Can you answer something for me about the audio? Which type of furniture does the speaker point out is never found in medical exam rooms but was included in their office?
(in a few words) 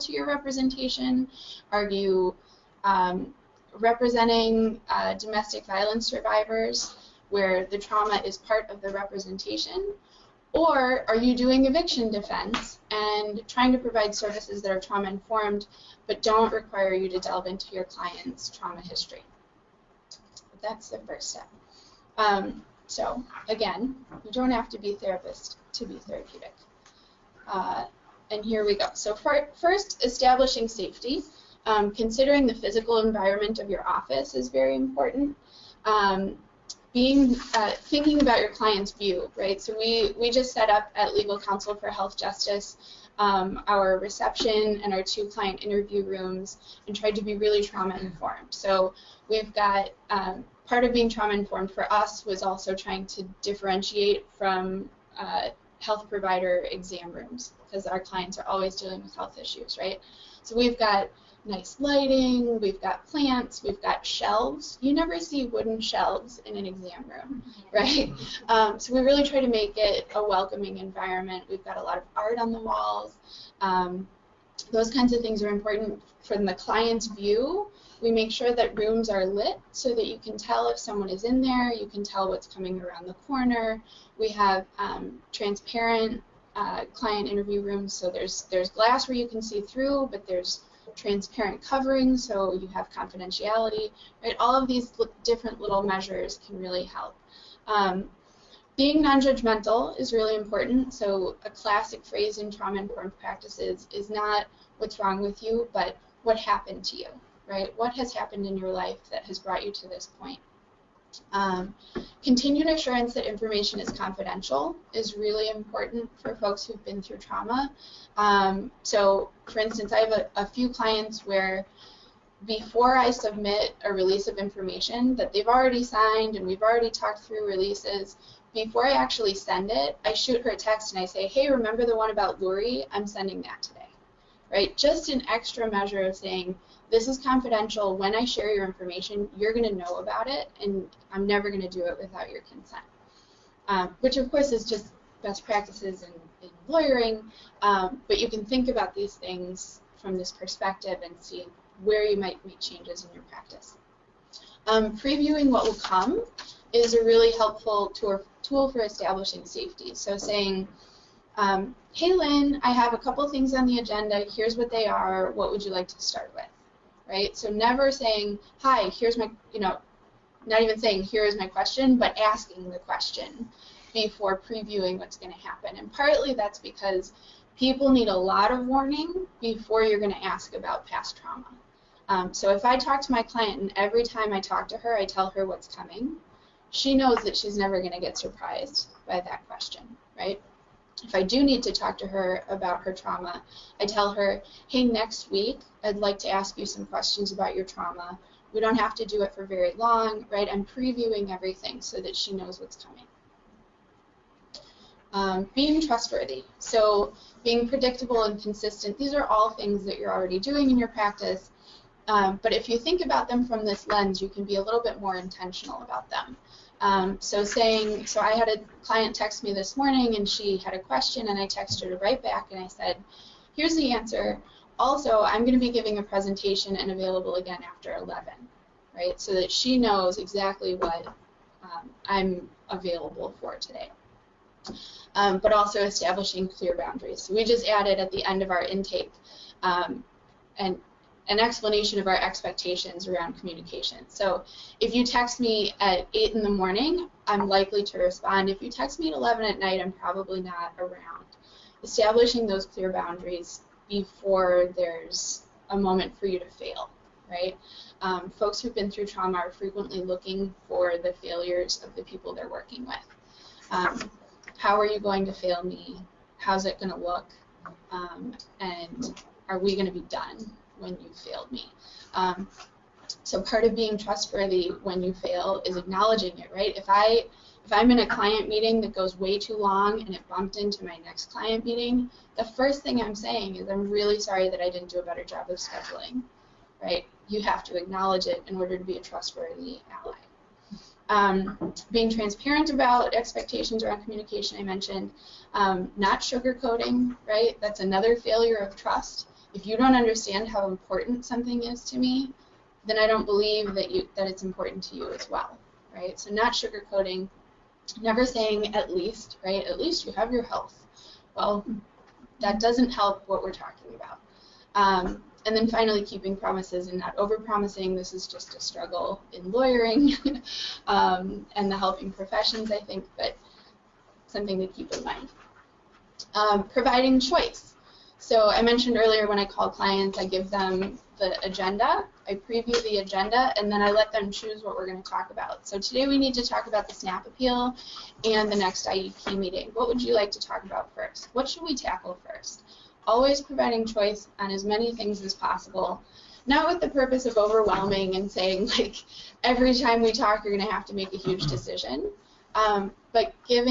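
wooden shelves.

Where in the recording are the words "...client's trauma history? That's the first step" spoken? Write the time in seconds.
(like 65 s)
17 s.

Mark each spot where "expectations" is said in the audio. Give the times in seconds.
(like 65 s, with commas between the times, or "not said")
242 s, 293 s.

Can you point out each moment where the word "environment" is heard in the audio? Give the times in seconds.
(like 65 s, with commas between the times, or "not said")
32 s, 70 s.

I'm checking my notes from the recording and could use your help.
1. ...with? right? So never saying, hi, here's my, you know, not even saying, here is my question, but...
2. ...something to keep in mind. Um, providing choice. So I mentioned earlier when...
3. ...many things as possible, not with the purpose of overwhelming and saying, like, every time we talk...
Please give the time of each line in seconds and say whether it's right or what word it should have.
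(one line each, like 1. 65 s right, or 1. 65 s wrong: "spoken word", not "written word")
1. 166 s right
2. 324 s right
3. 344 s right.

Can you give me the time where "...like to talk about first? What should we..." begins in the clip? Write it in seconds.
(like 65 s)
340 s.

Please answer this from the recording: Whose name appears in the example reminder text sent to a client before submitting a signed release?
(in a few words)
Lori.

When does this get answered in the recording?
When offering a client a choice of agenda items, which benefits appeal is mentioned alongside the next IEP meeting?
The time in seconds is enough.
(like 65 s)
336 s.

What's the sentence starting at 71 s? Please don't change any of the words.
We've got a lot of art on the walls.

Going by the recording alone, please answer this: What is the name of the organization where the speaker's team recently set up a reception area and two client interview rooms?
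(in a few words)
Legal Counsel for Health Justice.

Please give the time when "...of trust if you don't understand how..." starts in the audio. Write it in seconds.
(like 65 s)
298 s.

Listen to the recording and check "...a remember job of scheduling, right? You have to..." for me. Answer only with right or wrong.
wrong.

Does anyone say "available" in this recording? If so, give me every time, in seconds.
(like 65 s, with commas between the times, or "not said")
226 s, 232 s.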